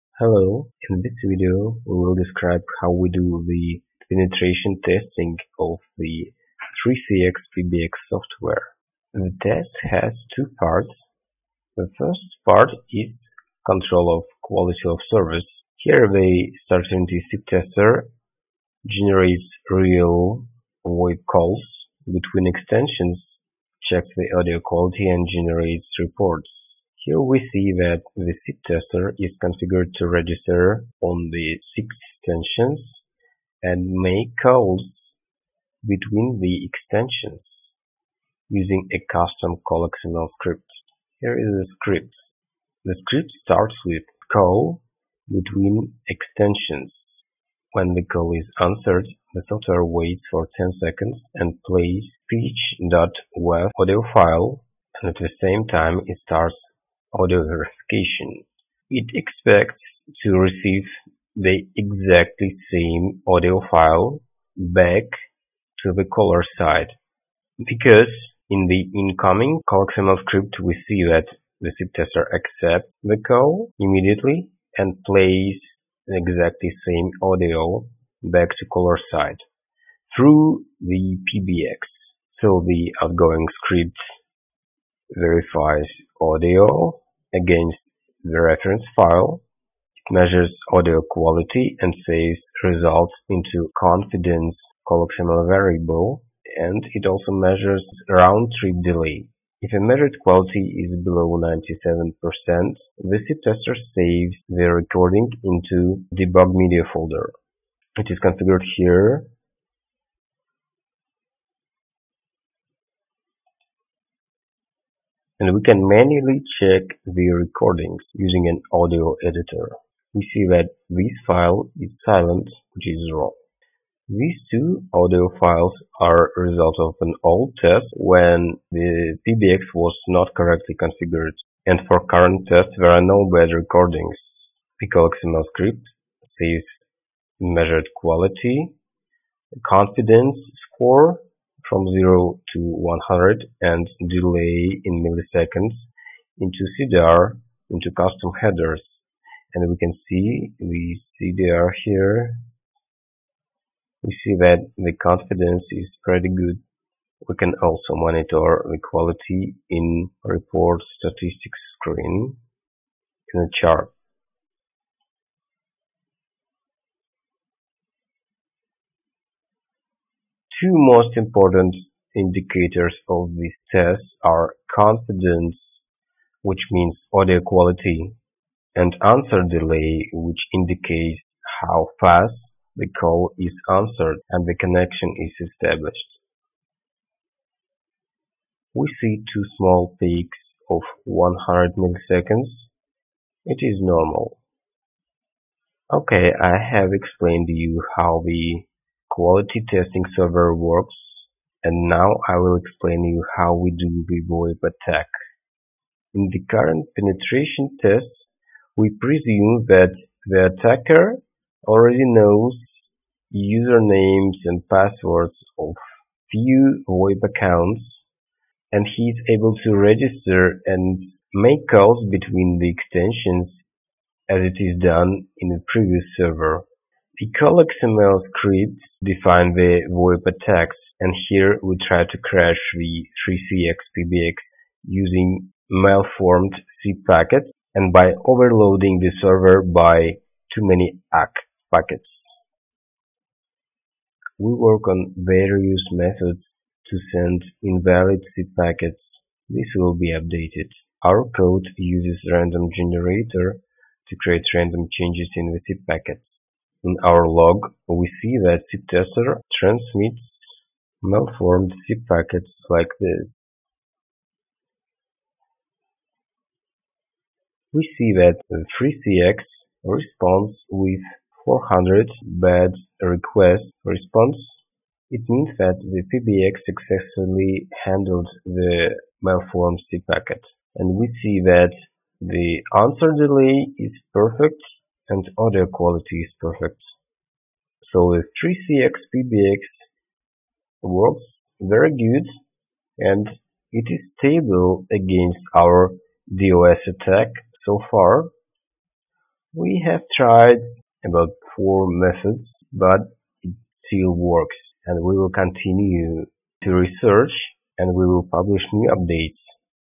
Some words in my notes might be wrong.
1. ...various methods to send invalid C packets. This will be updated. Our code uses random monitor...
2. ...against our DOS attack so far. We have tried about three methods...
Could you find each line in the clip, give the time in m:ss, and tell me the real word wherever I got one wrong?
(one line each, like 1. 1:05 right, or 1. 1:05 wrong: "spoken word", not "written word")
1. 4:05 wrong: "generator", not "monitor"
2. 4:54 wrong: "four", not "three".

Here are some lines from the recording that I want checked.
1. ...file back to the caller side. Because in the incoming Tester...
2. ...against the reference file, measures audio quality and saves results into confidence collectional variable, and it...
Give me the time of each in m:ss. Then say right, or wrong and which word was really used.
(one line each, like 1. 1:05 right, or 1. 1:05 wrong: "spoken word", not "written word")
1. 1:03 wrong: "CallXML", not "Tester"
2. 1:27 right.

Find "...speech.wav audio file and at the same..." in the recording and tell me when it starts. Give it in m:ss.
0:52.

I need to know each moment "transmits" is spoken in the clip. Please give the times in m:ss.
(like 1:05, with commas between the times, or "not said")
4:19.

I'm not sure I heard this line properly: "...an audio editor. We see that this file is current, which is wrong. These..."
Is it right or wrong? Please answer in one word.
wrong.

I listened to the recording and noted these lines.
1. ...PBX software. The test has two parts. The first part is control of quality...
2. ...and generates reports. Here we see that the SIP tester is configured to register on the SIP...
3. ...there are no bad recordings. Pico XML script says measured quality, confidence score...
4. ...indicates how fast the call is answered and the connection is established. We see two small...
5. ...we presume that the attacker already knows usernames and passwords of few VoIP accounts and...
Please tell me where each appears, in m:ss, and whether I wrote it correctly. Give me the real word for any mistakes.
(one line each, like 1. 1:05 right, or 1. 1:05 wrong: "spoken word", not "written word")
1. 0:07 right
2. 0:25 right
3. 2:12 right
4. 3:00 right
5. 3:28 right.